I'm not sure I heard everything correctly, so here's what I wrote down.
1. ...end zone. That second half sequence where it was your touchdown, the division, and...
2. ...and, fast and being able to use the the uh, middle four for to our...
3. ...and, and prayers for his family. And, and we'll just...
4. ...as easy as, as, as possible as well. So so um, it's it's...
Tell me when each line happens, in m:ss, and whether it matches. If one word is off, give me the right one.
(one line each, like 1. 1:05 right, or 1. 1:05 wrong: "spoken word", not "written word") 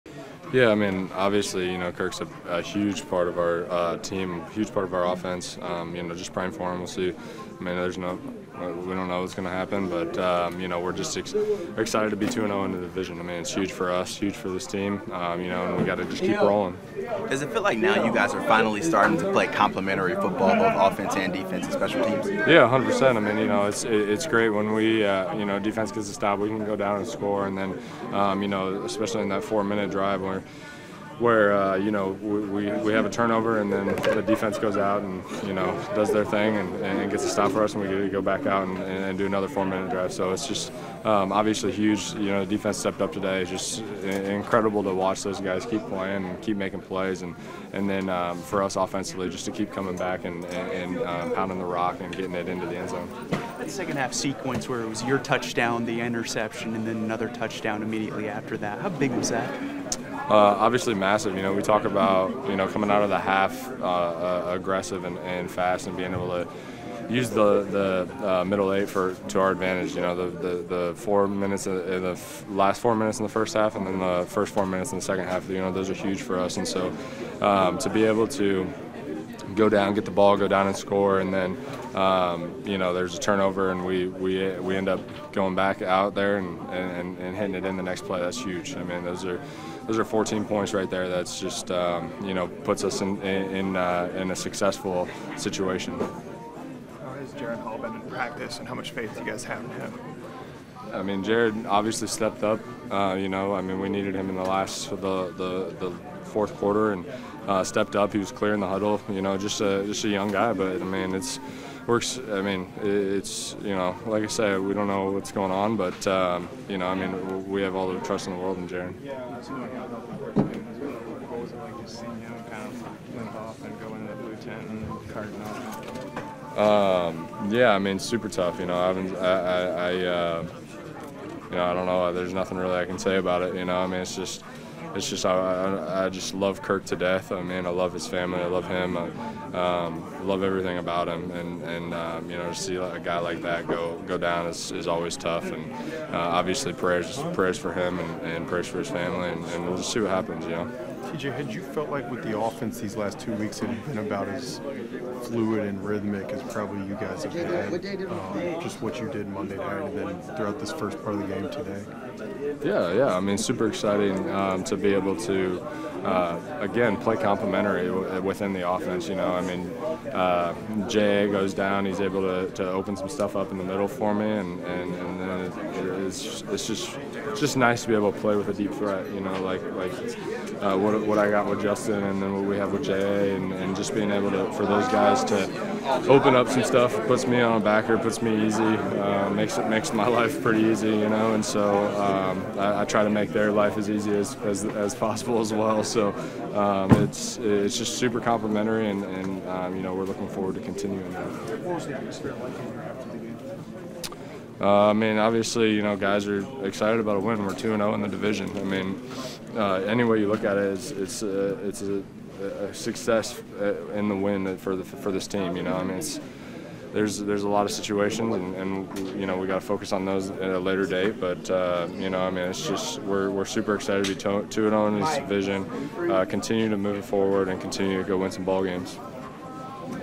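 1. 0:52 wrong: "interception", not "division"
2. 1:05 wrong: "eight", not "four"
3. 2:27 right
4. 3:13 right.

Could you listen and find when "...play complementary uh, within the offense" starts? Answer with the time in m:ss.
2:46.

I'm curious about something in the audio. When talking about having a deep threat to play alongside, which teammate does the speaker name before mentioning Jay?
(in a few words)
Justin.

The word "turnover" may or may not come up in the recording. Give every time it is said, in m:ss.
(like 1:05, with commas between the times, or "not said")
0:33, 1:23.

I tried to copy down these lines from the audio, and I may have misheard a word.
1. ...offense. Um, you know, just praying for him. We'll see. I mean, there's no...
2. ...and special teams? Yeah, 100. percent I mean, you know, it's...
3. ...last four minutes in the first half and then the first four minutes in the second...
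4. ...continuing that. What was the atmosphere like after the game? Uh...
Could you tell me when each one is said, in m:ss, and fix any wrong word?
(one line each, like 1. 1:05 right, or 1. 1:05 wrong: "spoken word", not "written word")
1. 0:05 right
2. 0:21 right
3. 1:12 right
4. 3:20 right.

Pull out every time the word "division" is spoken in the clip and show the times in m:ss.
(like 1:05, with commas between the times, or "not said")
0:12, 3:28.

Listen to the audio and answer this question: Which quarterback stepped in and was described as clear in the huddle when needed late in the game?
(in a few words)
Jaren Hall.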